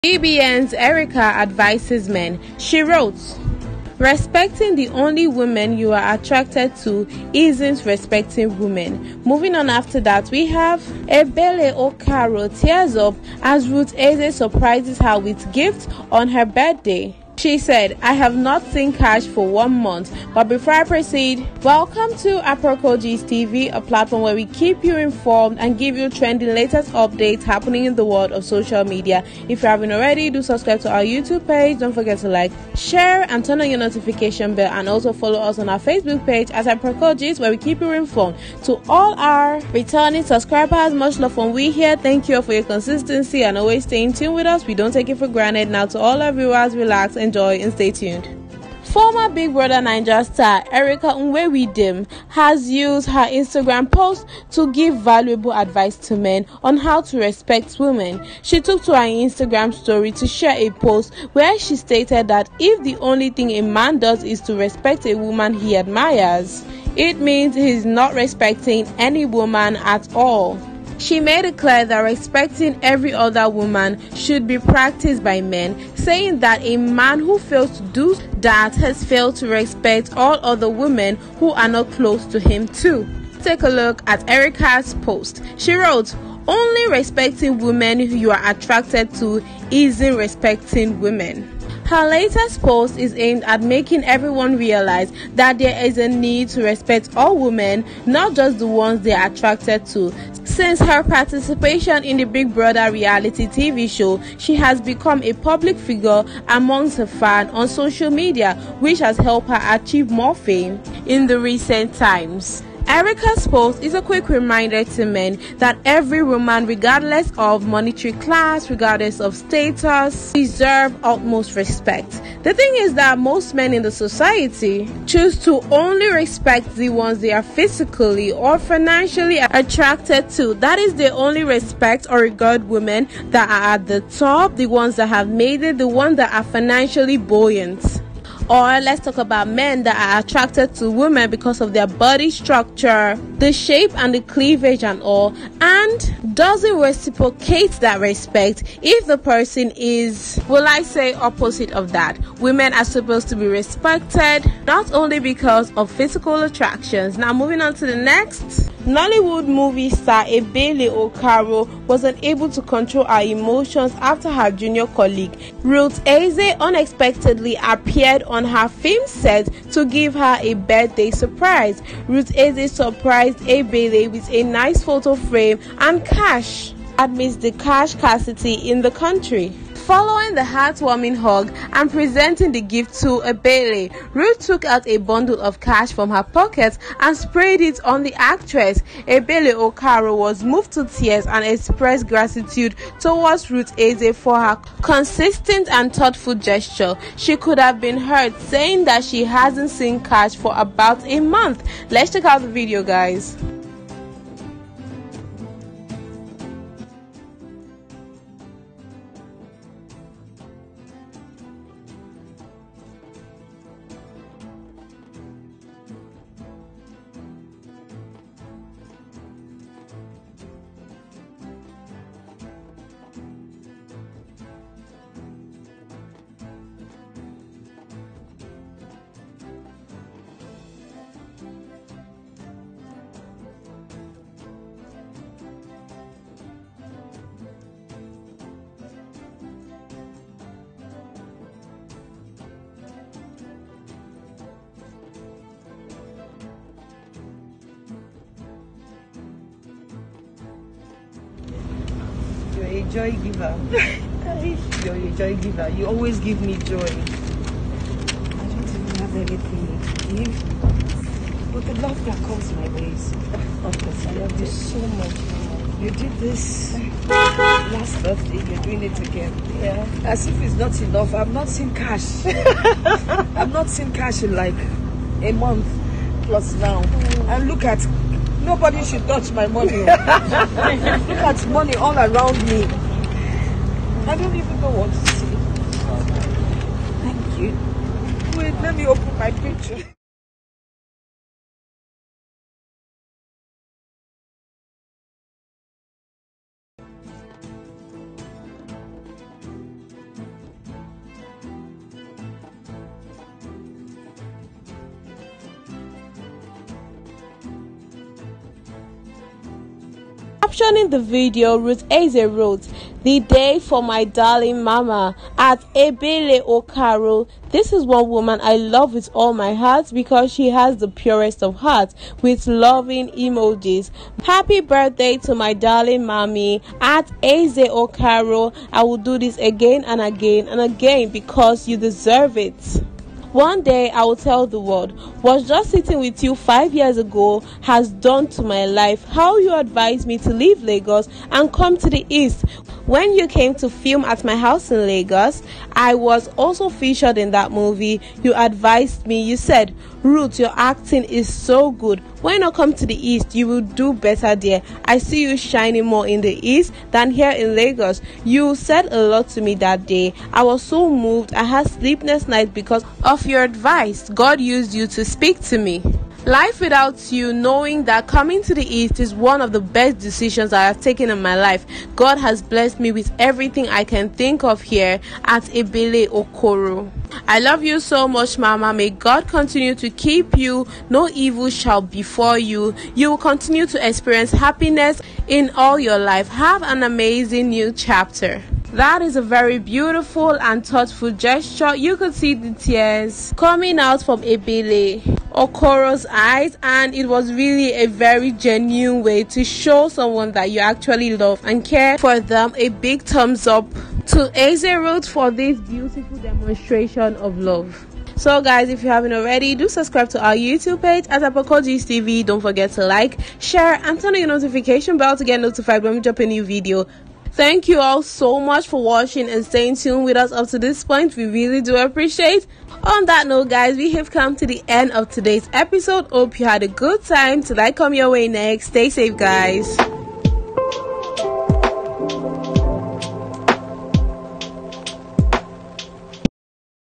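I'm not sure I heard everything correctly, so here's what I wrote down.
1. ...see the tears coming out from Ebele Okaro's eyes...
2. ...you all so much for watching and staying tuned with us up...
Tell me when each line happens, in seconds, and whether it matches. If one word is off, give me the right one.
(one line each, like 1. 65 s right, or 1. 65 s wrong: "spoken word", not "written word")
1. 392 s right
2. 417 s right.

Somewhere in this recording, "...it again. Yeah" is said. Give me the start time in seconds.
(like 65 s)
268 s.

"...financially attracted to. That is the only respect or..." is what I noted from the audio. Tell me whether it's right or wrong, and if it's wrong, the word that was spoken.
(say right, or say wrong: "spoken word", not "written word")
right.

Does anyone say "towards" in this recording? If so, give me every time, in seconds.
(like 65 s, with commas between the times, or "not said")
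192 s.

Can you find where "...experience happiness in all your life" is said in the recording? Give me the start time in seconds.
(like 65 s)
383 s.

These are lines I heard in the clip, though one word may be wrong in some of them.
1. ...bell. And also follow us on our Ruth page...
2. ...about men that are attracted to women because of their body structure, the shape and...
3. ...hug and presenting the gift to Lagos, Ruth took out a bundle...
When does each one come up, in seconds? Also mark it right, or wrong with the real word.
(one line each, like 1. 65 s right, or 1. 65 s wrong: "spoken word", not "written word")
1. 34 s wrong: "Facebook", not "Ruth"
2. 139 s right
3. 181 s wrong: "Ebele", not "Lagos".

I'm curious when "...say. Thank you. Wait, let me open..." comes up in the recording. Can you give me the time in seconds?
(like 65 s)
287 s.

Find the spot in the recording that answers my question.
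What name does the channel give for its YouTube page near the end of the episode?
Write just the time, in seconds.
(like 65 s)
411 s.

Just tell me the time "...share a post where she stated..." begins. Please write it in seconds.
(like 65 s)
60 s.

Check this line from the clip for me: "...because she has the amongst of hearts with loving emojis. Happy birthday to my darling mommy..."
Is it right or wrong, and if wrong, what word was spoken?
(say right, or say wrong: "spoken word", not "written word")
wrong: "purest", not "amongst".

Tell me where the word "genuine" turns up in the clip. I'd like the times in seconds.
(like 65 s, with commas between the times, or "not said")
398 s.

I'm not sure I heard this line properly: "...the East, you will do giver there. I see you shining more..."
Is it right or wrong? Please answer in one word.
wrong.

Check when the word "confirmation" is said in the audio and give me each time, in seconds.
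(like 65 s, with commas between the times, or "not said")
not said.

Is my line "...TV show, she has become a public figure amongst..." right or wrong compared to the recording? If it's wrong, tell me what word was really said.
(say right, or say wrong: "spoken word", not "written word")
right.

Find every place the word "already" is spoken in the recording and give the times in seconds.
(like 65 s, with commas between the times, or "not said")
29 s, 409 s.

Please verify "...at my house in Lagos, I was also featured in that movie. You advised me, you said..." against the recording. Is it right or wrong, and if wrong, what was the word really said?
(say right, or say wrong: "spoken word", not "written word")
right.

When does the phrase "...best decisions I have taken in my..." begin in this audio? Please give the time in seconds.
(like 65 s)
369 s.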